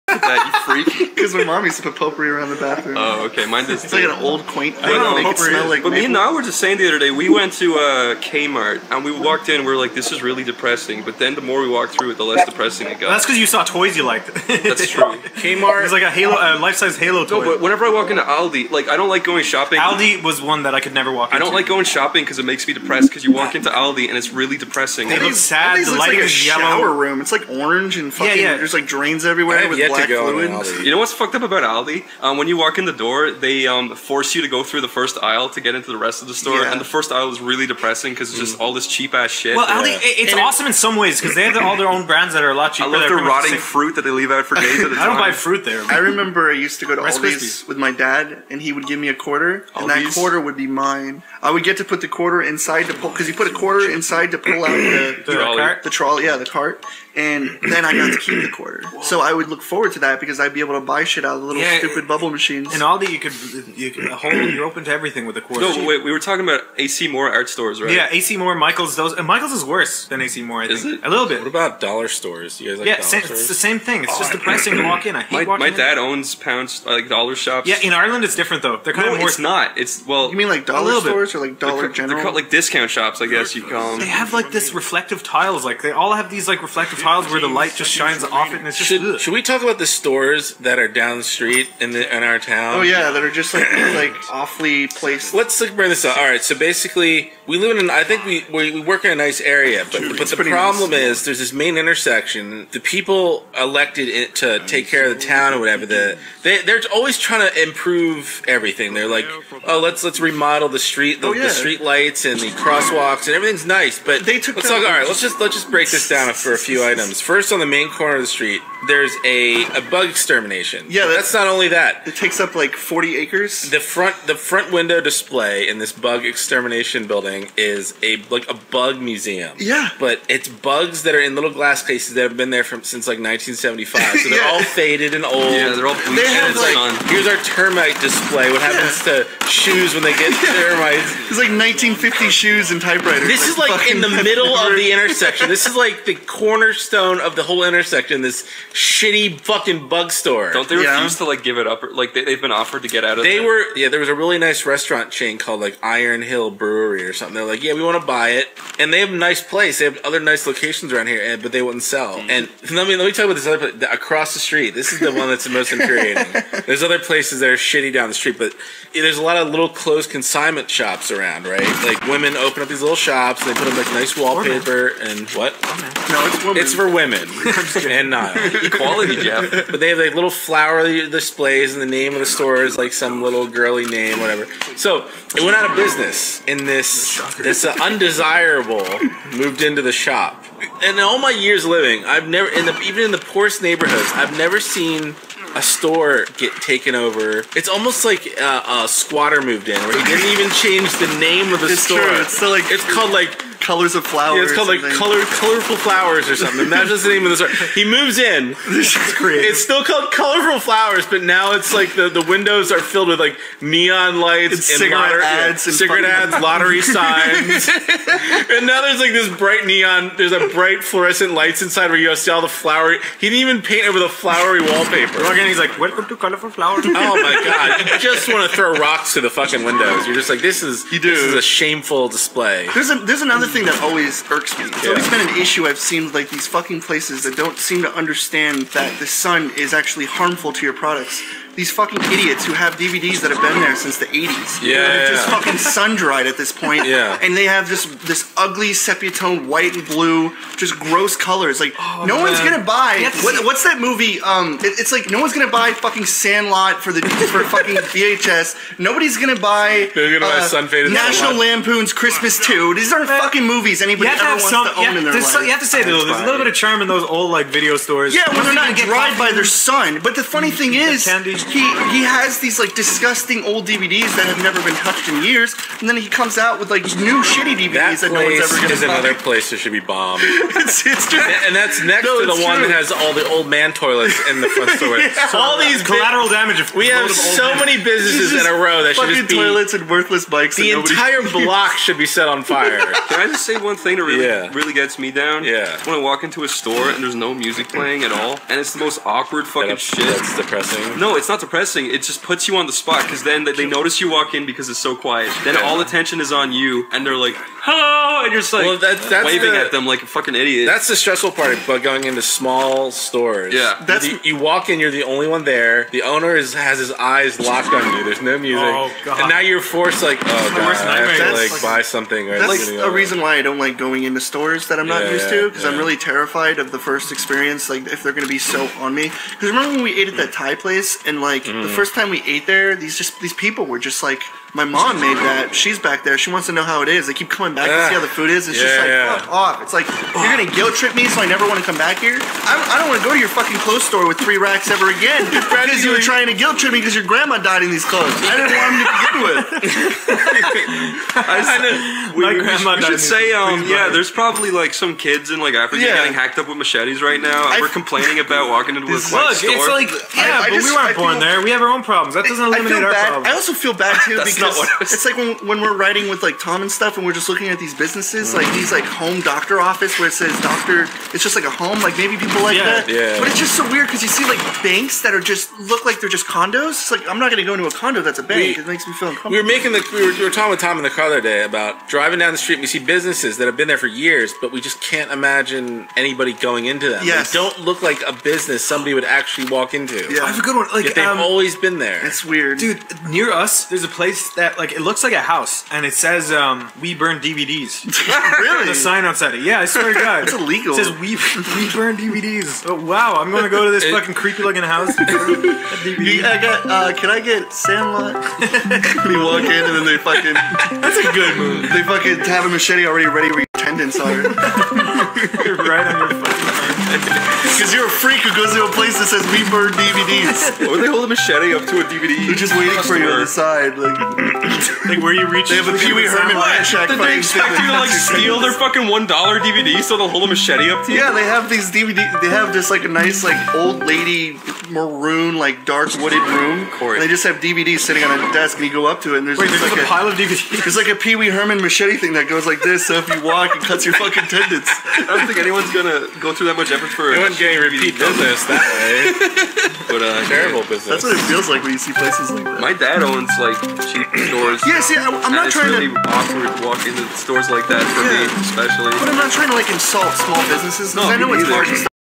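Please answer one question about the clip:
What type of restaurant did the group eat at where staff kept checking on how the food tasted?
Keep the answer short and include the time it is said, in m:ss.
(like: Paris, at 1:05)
Thai, at 5:30.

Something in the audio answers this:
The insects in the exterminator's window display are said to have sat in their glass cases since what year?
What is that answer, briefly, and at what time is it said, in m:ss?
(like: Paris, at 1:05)
1975, at 2:13.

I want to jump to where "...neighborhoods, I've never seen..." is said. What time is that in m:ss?
3:13.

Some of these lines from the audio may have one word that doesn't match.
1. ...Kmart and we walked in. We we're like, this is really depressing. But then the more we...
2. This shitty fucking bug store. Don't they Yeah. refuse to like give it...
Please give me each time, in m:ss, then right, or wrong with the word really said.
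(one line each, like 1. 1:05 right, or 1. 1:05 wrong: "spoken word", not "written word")
1. 0:08 right
2. 2:28 right.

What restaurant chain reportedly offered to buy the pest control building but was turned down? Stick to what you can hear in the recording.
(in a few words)
Iron Hill Brewery.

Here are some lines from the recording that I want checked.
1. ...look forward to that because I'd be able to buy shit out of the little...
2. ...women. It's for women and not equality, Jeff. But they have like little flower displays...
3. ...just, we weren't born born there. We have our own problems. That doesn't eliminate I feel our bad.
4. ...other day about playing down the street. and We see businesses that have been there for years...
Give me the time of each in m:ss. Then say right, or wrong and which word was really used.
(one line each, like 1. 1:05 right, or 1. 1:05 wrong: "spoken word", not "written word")
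1. 0:59 right
2. 2:56 right
3. 6:00 right
4. 6:21 wrong: "driving", not "playing".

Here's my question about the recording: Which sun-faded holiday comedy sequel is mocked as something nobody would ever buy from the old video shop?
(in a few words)
National Lampoon's Christmas 2.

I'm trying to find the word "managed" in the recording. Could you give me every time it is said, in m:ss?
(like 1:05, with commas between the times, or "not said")
not said.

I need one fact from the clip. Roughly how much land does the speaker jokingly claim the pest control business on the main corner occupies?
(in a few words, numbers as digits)
40 acres.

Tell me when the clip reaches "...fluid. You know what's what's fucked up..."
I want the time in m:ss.
0:30.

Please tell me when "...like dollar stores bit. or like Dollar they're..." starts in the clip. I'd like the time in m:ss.
1:20.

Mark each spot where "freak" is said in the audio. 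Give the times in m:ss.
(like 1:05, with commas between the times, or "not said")
0:00, 6:57.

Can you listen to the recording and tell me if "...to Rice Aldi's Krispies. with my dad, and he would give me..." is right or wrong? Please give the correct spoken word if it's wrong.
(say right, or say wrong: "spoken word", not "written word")
right.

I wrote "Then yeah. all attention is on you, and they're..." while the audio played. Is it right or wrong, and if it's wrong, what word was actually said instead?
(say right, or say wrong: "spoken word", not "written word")
right.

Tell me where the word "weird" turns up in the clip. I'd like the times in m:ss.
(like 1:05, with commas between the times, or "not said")
6:13, 6:32.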